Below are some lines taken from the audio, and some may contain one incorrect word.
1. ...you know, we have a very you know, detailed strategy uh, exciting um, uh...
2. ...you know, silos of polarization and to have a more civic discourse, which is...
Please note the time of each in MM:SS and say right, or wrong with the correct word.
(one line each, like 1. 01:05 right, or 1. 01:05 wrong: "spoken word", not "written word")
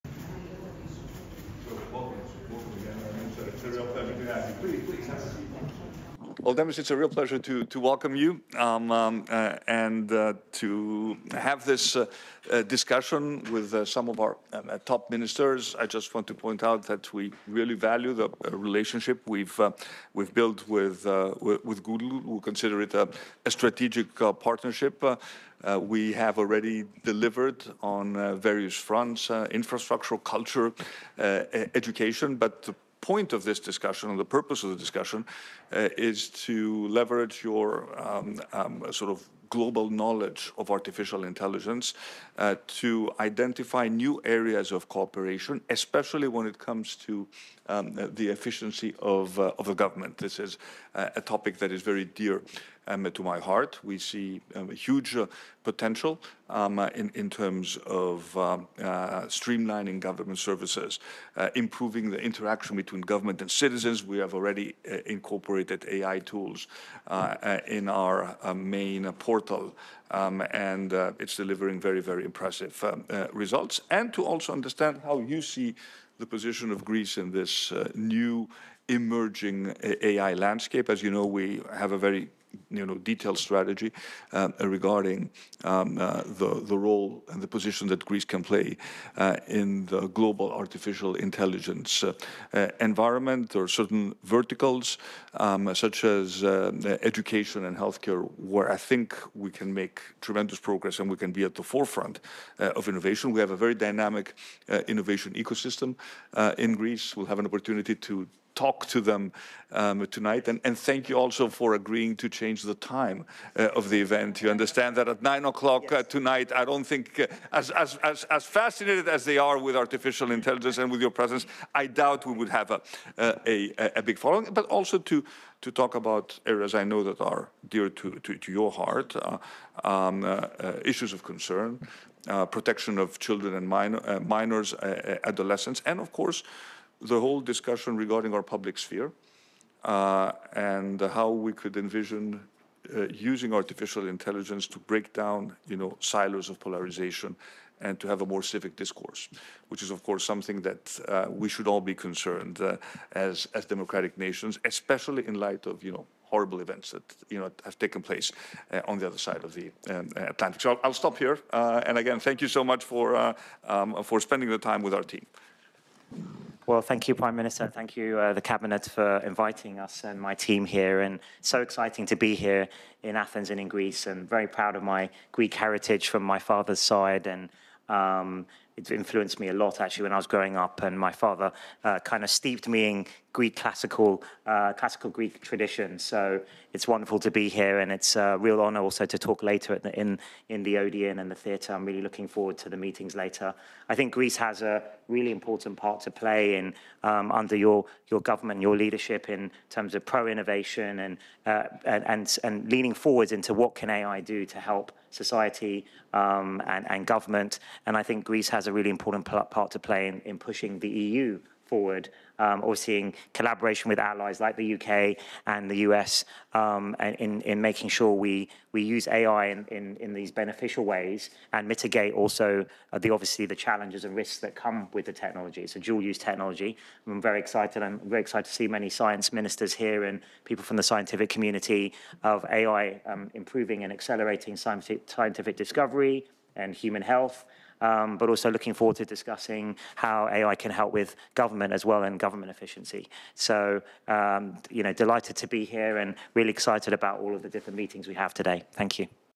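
1. 01:21 wrong: "regarding", not "exciting"
2. 02:25 right.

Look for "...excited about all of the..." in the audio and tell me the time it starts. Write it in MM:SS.
04:06.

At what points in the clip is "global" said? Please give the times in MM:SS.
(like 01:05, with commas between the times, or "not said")
00:39, 01:30.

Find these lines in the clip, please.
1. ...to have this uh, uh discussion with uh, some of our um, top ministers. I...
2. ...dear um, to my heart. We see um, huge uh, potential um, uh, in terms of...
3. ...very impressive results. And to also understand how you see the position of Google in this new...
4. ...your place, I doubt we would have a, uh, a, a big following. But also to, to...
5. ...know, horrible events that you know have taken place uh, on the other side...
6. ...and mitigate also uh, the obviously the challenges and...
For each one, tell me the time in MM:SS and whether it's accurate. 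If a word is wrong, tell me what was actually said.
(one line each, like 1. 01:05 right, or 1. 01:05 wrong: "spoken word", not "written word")
1. 00:10 right
2. 00:52 right
3. 01:12 wrong: "Greece", not "Google"
4. 02:01 wrong: "presence", not "place"
5. 02:35 right
6. 03:41 right.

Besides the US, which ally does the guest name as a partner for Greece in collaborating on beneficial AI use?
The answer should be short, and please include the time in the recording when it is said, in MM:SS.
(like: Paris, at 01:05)
UK, at 03:34.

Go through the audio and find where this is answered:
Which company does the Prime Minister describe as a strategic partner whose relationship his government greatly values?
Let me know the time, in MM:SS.
00:21.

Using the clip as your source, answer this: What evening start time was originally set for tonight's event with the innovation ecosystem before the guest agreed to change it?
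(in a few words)
9 o'clock.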